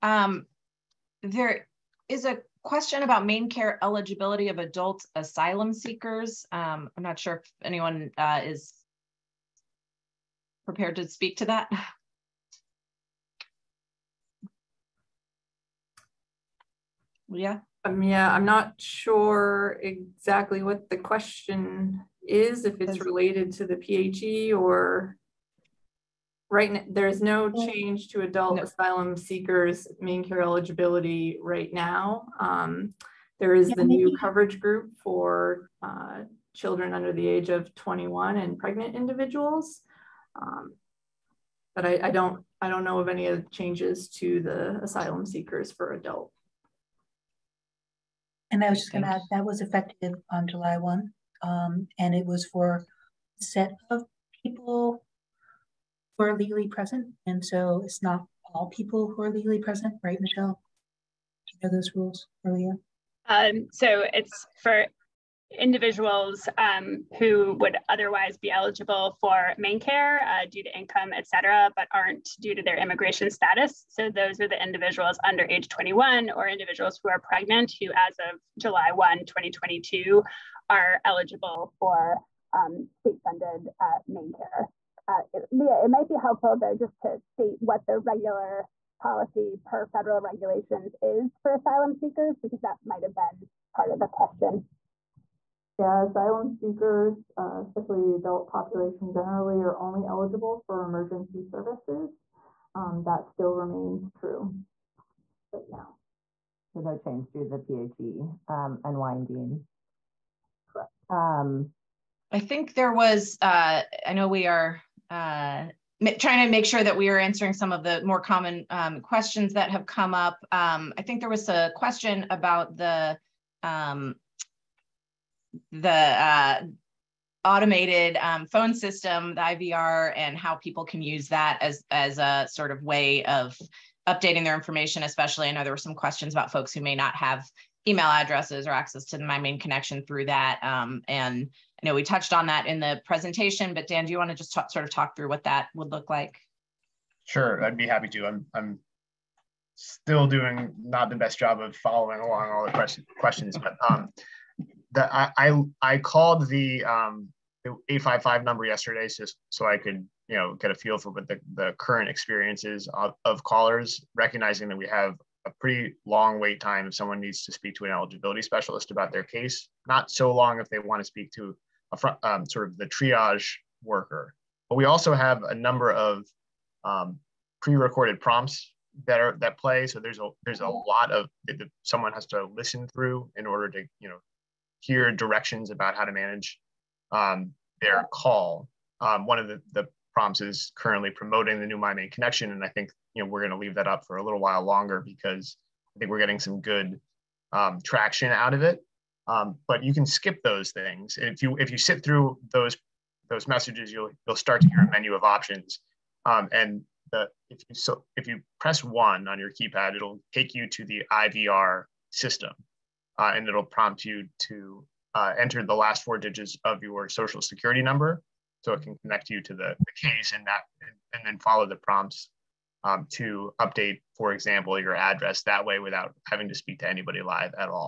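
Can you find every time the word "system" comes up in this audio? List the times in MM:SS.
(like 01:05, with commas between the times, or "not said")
02:08, 03:32.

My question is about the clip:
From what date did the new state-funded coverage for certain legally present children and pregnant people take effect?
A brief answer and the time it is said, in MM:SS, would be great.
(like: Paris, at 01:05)
July 1, 2022, at 01:18.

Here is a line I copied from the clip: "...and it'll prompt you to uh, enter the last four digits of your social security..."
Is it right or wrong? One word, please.
right.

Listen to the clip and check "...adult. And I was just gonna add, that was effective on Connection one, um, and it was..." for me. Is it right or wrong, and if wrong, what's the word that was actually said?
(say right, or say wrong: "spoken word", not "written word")
wrong: "July", not "Connection".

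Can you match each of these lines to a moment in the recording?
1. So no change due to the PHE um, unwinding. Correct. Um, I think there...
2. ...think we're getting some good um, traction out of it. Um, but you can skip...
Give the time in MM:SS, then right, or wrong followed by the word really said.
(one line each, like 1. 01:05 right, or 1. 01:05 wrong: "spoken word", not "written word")
1. 01:46 right
2. 03:15 right.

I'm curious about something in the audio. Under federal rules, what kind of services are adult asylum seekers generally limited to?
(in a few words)
Emergency services.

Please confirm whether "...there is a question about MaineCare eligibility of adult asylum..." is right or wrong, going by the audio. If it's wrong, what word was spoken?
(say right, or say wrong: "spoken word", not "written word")
right.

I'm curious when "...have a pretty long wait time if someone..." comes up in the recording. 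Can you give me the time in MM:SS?
02:44.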